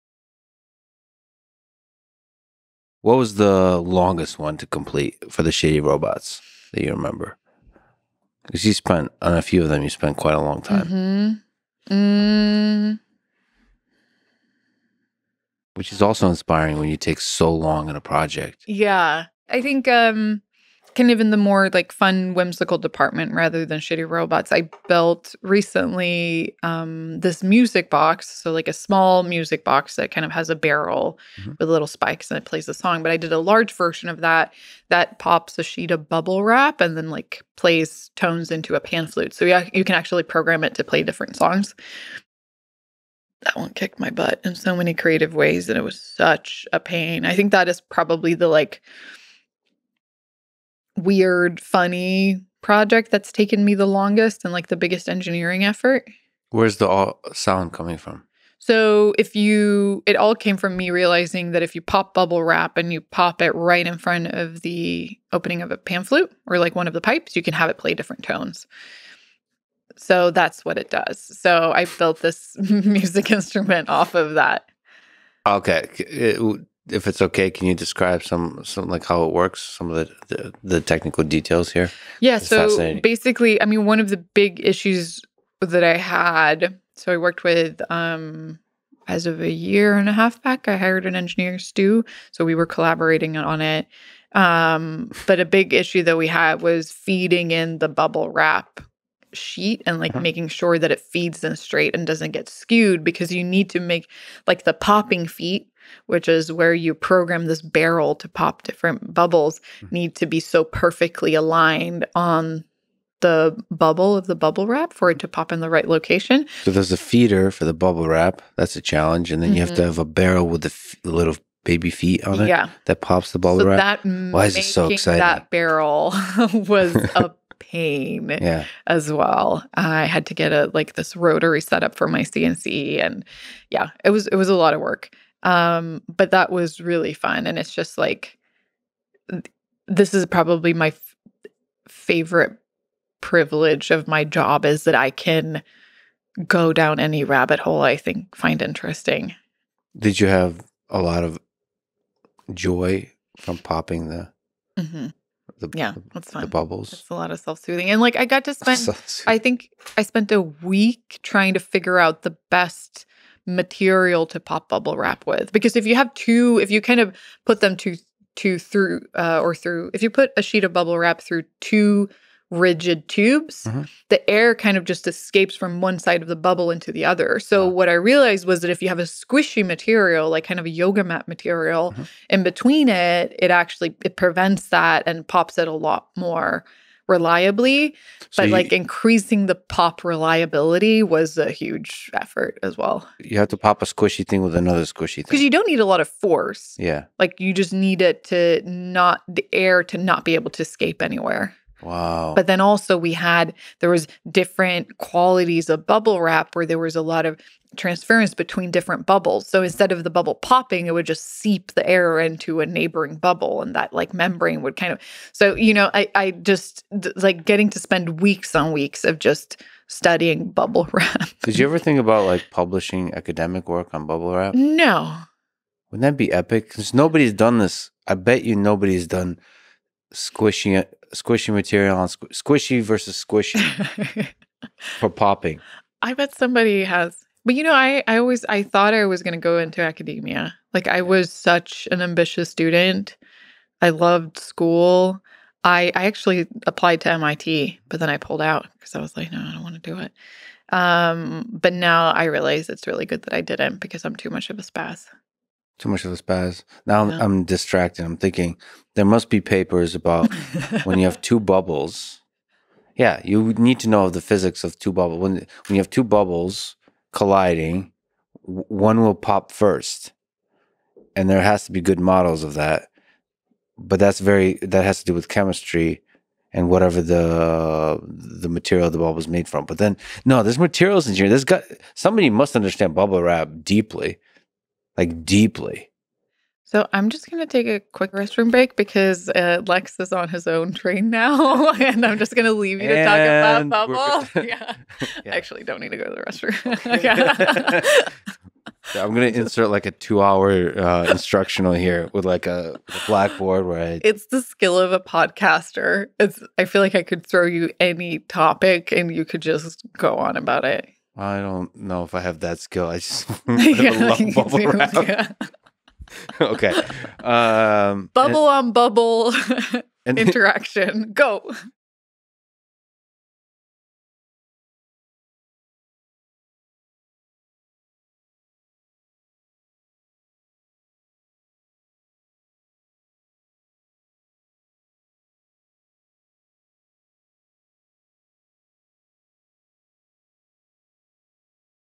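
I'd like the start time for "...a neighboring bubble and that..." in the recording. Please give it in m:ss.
3:32.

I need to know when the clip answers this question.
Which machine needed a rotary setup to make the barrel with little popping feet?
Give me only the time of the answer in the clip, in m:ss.
2:12.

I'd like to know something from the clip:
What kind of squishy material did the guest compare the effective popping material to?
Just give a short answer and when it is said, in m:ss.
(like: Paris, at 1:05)
Yoga mat, at 3:00.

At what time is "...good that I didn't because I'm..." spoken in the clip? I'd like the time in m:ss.
4:13.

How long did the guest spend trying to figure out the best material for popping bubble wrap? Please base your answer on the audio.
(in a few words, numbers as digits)
A week.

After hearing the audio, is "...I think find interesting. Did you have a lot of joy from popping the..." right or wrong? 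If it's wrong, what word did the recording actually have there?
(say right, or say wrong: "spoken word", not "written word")
right.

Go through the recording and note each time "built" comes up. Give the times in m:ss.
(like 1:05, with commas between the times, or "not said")
0:24, 1:11.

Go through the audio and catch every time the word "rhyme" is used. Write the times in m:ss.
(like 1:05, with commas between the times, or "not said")
not said.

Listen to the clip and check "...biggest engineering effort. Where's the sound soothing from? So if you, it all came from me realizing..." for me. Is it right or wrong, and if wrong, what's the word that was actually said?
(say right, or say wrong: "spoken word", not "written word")
wrong: "coming", not "soothing".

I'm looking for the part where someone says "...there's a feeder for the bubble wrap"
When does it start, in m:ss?
1:56.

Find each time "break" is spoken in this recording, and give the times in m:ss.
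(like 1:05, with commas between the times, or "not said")
4:48.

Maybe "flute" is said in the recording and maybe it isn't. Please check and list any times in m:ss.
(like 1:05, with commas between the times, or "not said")
0:39, 1:06.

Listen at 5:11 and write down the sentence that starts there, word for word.
I don't know if I have that skill.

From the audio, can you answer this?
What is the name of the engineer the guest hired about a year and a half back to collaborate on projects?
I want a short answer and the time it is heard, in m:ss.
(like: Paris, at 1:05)
Stu, at 1:31.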